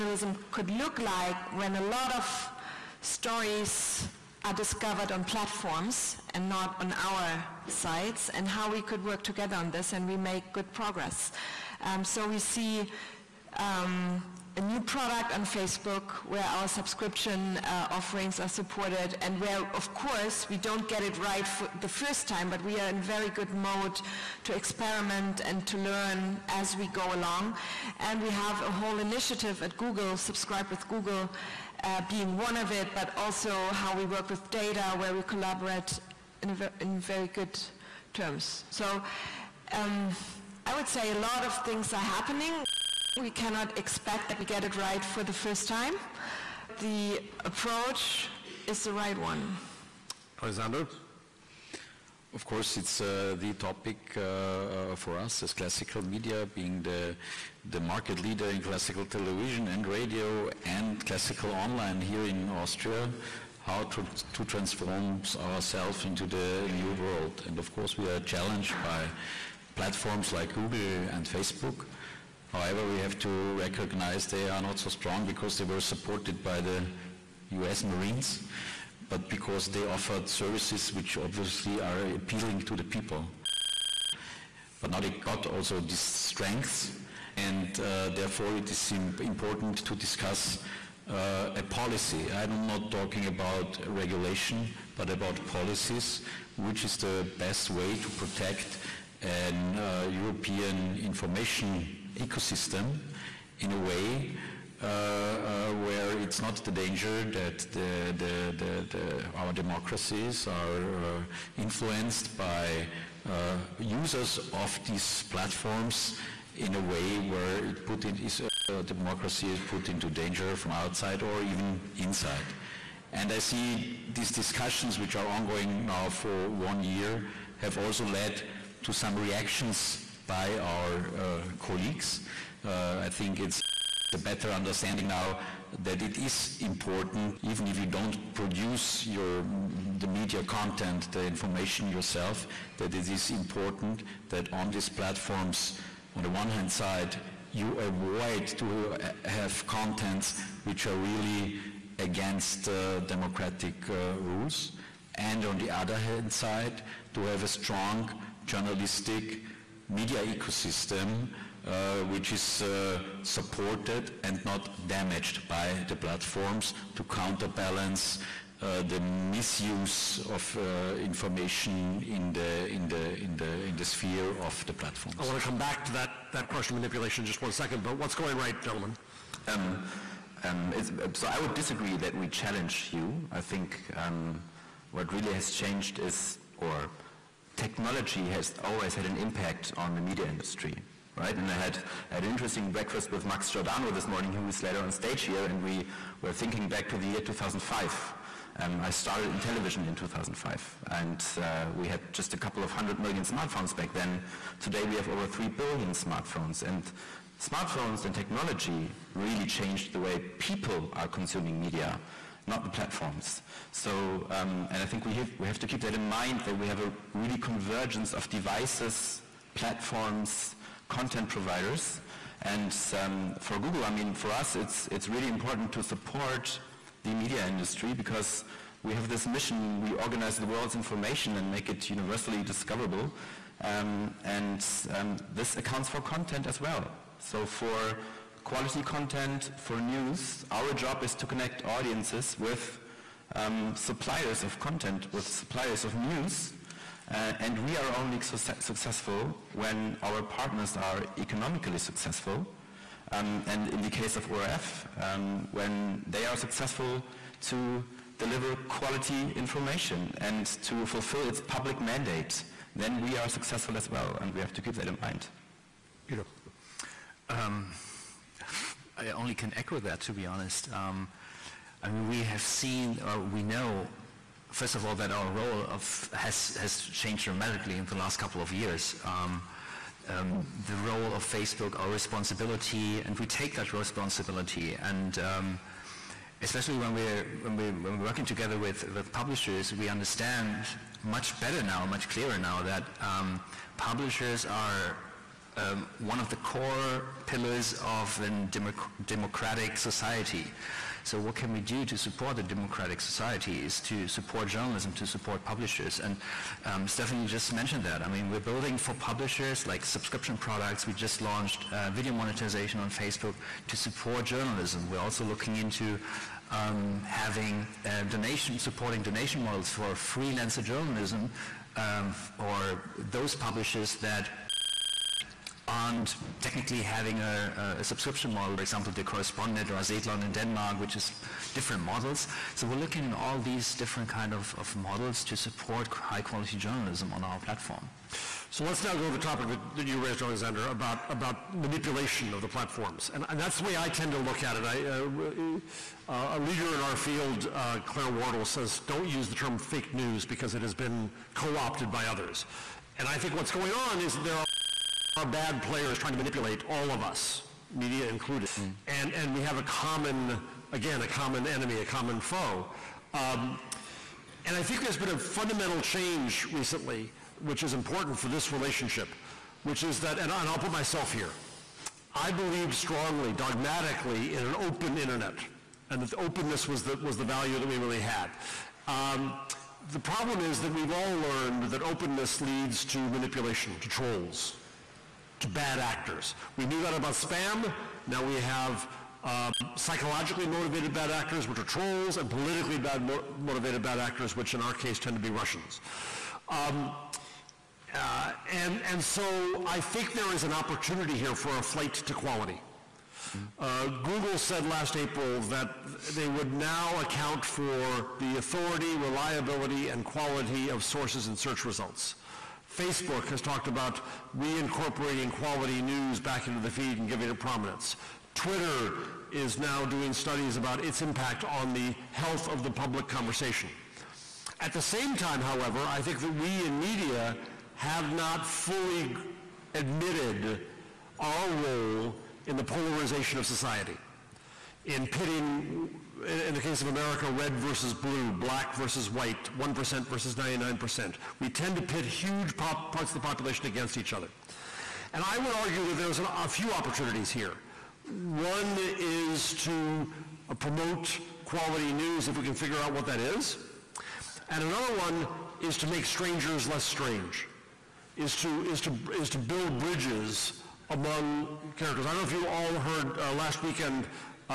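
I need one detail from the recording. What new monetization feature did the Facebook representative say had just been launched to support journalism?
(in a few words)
video monetization.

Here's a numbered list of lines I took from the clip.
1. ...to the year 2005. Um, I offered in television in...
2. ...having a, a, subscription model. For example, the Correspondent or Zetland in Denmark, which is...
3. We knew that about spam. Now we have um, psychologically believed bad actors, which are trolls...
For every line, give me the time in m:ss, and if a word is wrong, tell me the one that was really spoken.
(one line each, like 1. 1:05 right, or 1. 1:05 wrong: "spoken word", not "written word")
1. 3:16 wrong: "started", not "offered"
2. 5:26 right
3. 6:26 wrong: "motivated", not "believed".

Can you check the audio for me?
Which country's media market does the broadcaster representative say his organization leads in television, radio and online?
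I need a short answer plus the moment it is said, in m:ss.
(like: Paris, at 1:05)
Austria, at 1:02.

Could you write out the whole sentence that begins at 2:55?
I want to come back to that, that question of manipulation in just one second, but what's going right, gentlemen?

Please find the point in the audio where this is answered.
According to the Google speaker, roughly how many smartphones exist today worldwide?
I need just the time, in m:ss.
3:25.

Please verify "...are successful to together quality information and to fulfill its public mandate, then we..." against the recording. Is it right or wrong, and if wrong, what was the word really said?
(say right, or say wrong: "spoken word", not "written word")
wrong: "deliver", not "together".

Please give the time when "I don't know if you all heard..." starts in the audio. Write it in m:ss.
7:42.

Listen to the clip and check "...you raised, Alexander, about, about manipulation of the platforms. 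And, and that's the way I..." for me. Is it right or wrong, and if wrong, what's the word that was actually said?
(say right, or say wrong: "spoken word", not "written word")
right.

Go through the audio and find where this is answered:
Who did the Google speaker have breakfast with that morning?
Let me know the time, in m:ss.
3:13.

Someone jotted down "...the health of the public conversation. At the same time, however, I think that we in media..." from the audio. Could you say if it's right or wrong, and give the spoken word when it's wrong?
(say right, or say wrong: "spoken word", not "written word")
right.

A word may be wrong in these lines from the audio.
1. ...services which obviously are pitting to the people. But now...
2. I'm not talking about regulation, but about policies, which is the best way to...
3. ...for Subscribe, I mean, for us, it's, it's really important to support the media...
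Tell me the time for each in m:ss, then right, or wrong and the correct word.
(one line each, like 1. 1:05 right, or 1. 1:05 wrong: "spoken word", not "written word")
1. 1:20 wrong: "appealing", not "pitting"
2. 1:32 right
3. 3:43 wrong: "Google", not "Subscribe".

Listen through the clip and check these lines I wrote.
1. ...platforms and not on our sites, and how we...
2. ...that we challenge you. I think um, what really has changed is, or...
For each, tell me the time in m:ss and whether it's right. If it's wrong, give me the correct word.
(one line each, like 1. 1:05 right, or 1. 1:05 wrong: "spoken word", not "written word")
1. 0:05 right
2. 3:01 right.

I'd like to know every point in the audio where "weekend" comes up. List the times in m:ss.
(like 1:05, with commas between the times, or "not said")
7:43.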